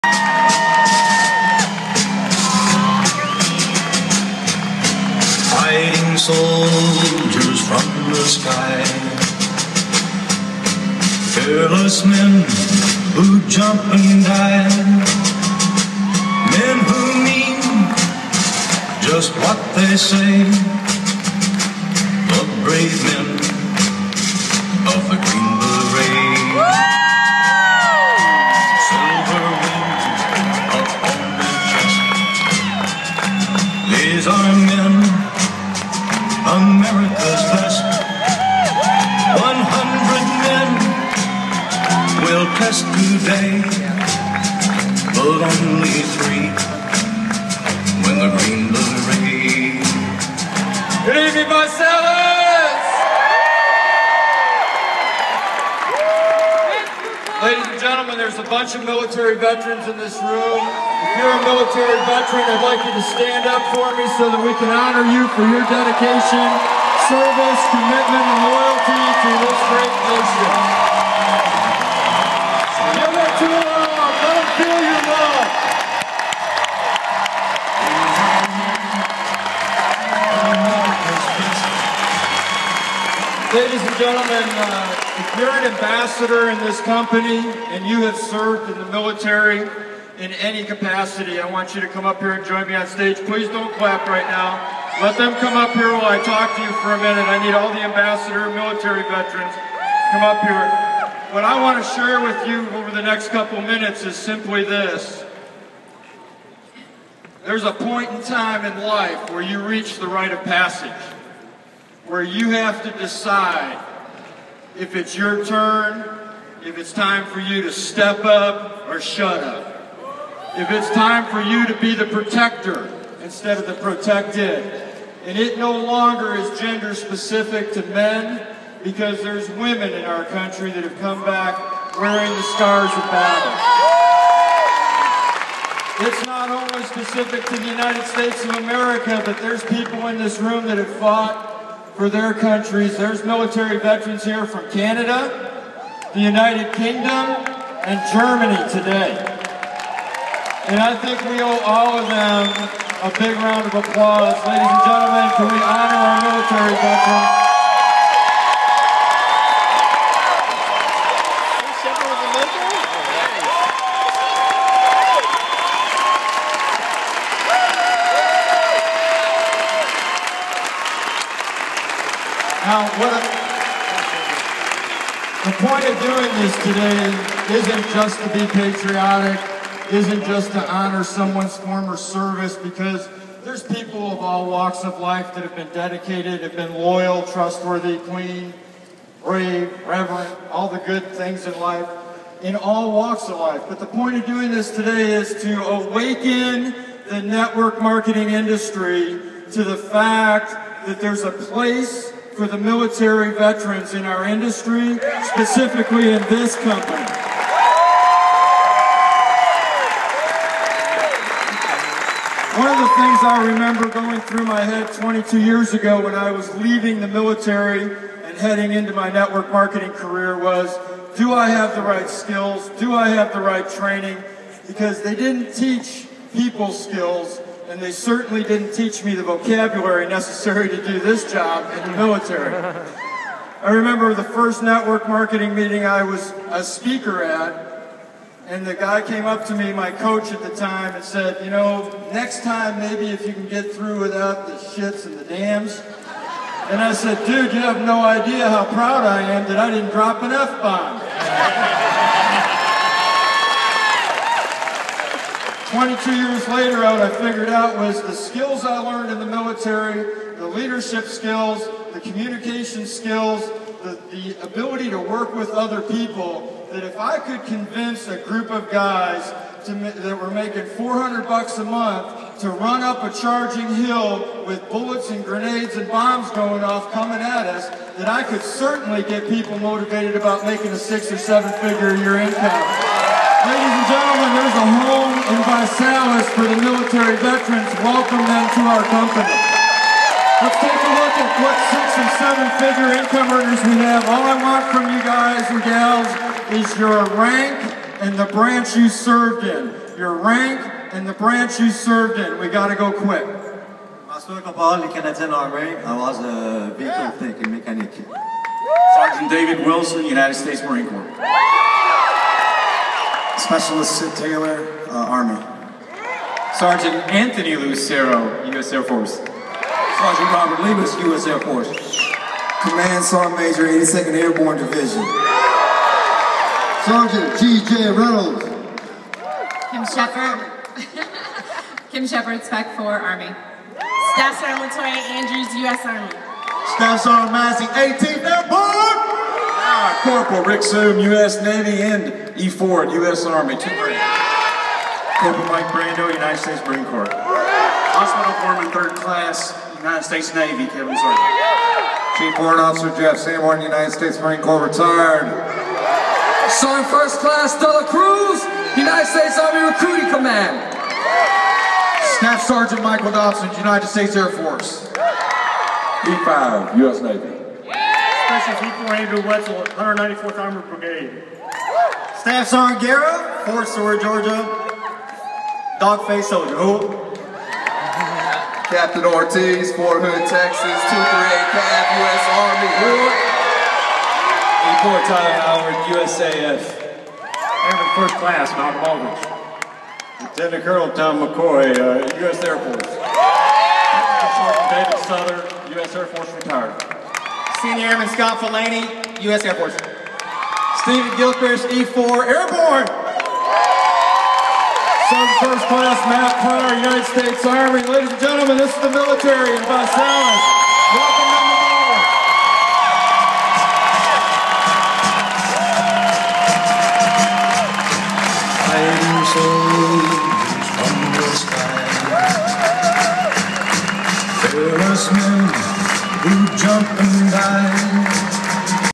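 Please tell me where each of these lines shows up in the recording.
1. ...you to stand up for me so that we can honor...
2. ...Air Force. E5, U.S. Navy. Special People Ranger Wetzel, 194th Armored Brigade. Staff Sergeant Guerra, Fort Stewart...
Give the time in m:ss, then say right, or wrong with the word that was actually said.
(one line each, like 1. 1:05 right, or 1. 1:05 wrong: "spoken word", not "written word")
1. 1:02 right
2. 6:04 right.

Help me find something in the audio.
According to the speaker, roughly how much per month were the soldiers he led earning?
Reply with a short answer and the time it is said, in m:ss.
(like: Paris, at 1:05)
$400, at 4:30.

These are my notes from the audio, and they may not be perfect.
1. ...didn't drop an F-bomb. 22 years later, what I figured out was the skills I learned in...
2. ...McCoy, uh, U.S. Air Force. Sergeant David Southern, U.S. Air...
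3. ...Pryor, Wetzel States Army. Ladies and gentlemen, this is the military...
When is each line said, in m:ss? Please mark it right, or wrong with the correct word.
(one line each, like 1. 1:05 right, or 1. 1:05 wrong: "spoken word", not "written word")
1. 4:09 right
2. 6:31 right
3. 6:46 wrong: "United", not "Wetzel".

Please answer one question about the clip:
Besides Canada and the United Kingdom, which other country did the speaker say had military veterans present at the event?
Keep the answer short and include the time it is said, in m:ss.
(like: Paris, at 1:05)
Germany, at 2:28.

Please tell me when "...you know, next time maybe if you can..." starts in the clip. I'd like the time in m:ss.
4:01.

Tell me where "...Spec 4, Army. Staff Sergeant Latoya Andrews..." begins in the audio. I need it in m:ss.
5:32.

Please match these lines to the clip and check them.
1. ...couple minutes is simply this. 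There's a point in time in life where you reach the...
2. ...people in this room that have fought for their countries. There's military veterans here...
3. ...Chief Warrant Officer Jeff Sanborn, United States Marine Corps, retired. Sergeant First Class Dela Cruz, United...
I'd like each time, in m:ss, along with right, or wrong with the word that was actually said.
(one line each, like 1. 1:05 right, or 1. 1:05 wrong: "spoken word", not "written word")
1. 1:43 right
2. 2:19 right
3. 5:52 right.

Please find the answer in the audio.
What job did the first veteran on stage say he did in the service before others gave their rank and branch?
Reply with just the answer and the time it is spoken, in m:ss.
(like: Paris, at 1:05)
Vehicle mechanic, at 5:06.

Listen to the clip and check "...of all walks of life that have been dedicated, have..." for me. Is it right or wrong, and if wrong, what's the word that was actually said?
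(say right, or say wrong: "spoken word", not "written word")
right.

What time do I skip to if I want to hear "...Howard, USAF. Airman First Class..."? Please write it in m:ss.
6:25.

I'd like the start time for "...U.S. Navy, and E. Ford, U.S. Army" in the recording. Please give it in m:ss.
5:40.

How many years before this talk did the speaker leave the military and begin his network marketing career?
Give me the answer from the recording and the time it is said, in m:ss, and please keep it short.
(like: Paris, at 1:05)
22, at 3:34.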